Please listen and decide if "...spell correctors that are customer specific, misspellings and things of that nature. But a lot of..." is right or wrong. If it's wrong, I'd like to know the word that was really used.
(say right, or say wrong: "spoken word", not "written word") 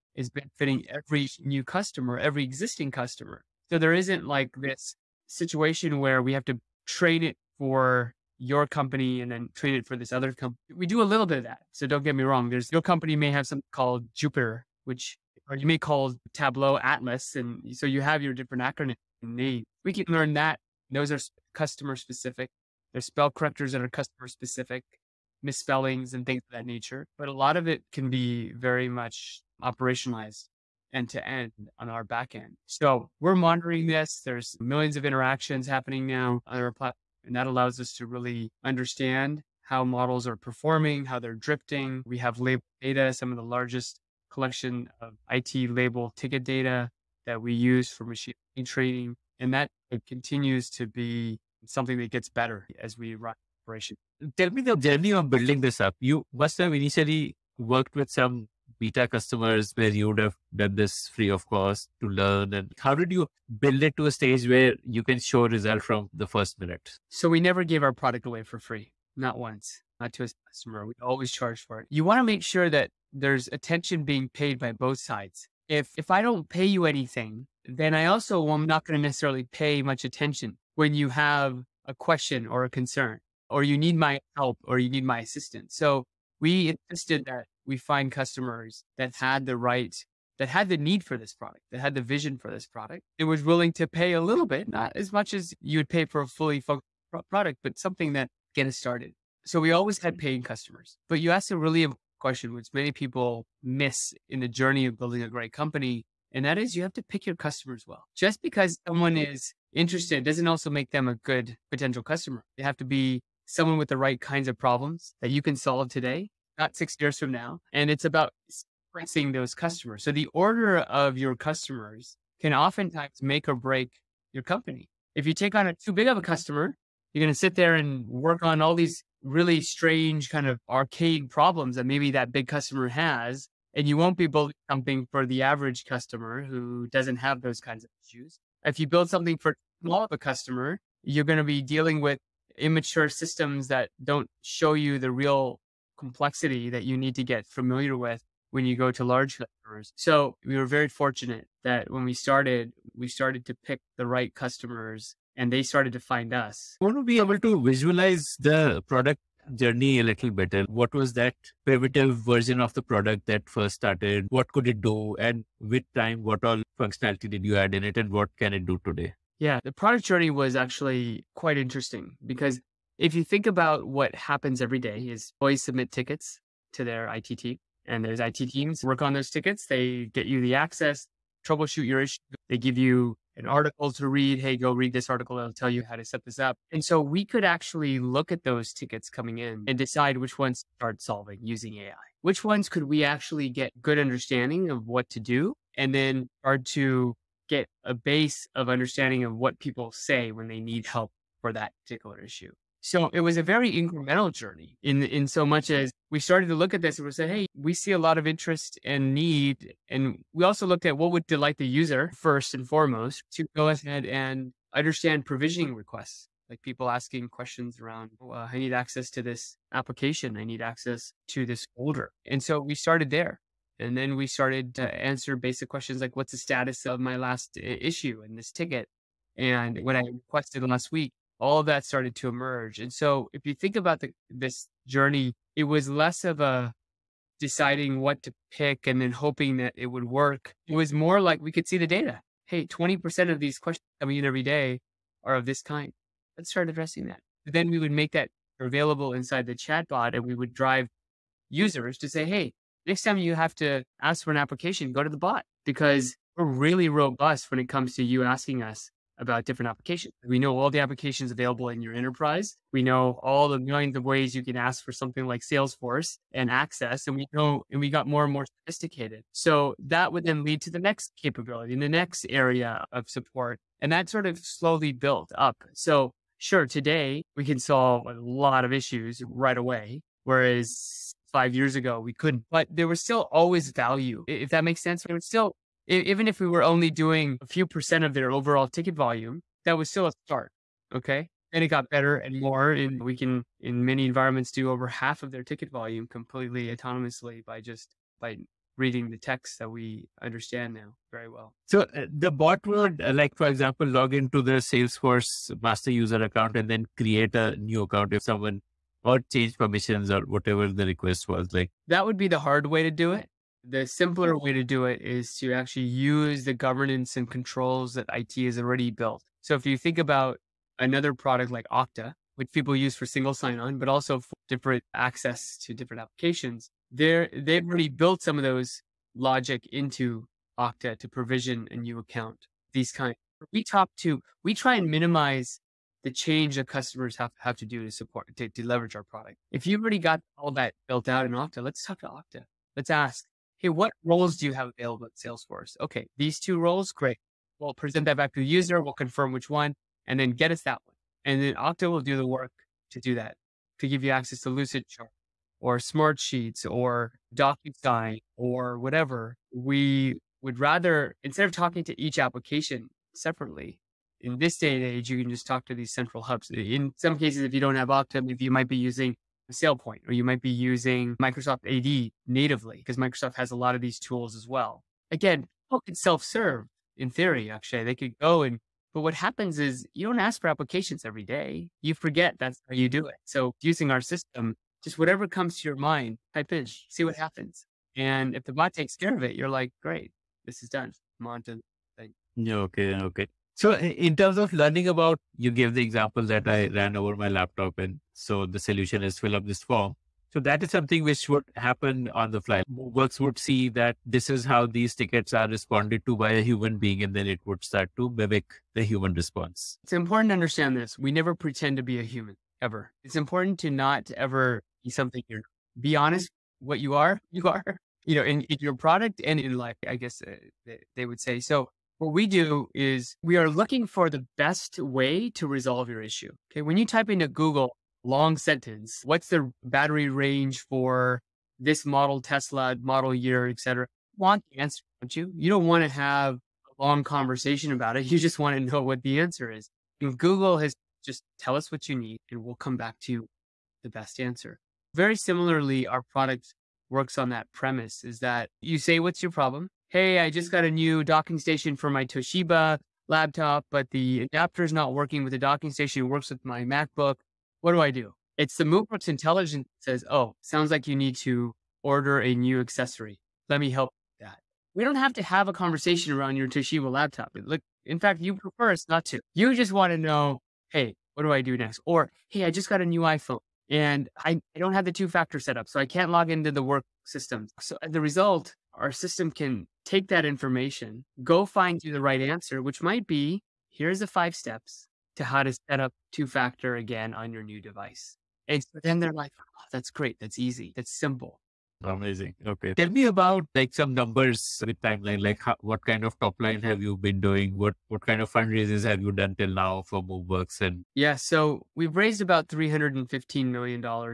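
right.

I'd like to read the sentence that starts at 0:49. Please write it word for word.
And that uh, continues to be something that gets better as we run operation.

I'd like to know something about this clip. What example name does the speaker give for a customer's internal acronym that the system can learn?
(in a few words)
Jupiter.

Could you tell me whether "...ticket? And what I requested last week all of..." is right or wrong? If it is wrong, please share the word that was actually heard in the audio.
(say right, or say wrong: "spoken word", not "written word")
right.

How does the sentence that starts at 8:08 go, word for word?
And so then they're like, oh, that's great.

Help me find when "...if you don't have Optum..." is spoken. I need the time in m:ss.
6:07.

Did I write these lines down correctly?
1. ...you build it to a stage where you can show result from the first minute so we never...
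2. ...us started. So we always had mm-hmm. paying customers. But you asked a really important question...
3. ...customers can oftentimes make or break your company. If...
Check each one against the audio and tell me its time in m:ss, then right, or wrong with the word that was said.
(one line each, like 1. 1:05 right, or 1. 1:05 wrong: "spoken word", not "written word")
1. 1:03 right
2. 1:38 right
3. 2:01 right.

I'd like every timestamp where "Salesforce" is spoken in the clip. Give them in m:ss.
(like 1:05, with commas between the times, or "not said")
4:25, 5:04, 5:45.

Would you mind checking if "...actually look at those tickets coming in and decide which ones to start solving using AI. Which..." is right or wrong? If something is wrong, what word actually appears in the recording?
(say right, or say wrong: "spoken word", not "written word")
right.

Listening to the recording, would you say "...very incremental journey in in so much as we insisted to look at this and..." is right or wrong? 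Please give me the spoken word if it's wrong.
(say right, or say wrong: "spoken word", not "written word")
wrong: "started", not "insisted".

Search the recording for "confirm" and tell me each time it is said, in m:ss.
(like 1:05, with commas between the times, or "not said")
5:48.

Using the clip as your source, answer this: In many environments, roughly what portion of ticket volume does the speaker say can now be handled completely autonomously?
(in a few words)
over half.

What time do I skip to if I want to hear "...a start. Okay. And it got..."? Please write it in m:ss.
4:50.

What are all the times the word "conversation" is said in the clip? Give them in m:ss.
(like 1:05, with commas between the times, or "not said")
7:17, 7:45.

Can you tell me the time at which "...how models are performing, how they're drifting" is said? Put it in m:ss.
0:39.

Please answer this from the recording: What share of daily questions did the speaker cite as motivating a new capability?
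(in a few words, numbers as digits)
20%.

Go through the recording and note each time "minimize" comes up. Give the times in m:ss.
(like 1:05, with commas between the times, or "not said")
5:34.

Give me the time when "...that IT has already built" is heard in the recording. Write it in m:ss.
5:17.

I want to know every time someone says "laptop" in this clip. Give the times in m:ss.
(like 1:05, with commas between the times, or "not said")
6:37, 7:33, 7:46.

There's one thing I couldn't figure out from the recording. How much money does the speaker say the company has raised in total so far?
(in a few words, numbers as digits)
$315 million.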